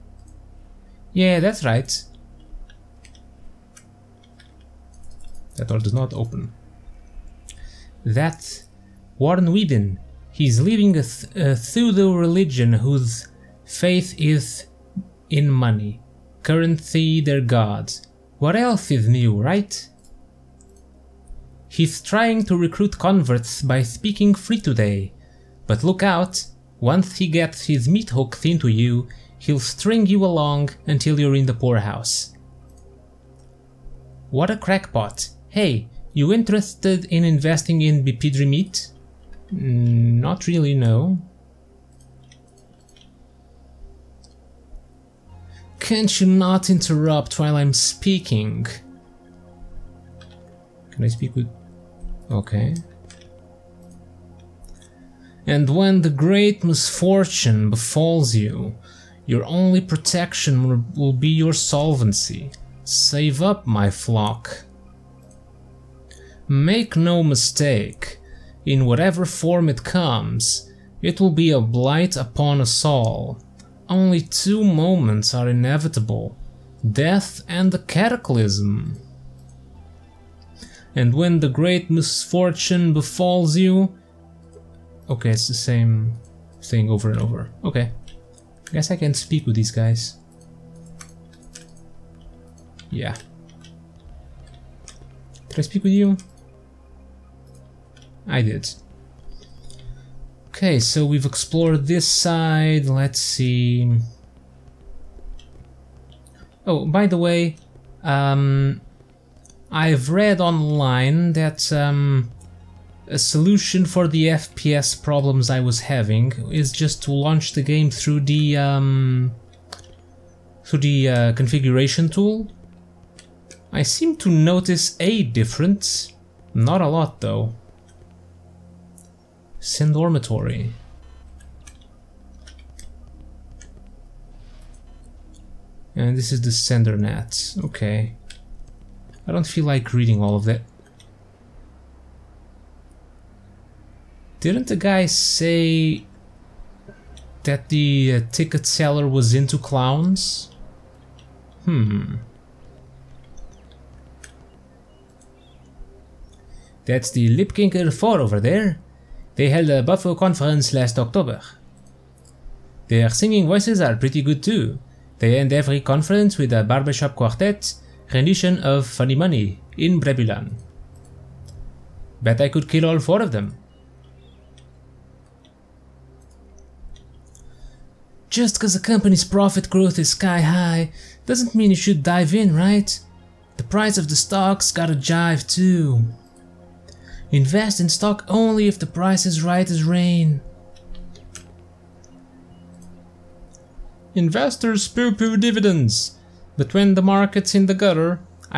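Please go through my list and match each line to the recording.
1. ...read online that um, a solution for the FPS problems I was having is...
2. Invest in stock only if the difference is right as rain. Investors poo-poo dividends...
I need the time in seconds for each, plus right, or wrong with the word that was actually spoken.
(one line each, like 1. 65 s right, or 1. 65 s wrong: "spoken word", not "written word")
1. 110 s right
2. 187 s wrong: "price", not "difference".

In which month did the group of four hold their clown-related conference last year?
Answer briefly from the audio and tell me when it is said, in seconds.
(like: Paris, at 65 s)
October, at 160 s.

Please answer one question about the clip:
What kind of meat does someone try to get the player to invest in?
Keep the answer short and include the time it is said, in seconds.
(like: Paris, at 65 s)
Bipidry meat, at 38 s.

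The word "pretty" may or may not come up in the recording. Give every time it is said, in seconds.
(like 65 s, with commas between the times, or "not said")
163 s.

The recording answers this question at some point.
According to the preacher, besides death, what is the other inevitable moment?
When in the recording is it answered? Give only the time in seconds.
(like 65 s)
77 s.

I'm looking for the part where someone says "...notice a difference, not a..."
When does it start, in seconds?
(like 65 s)
124 s.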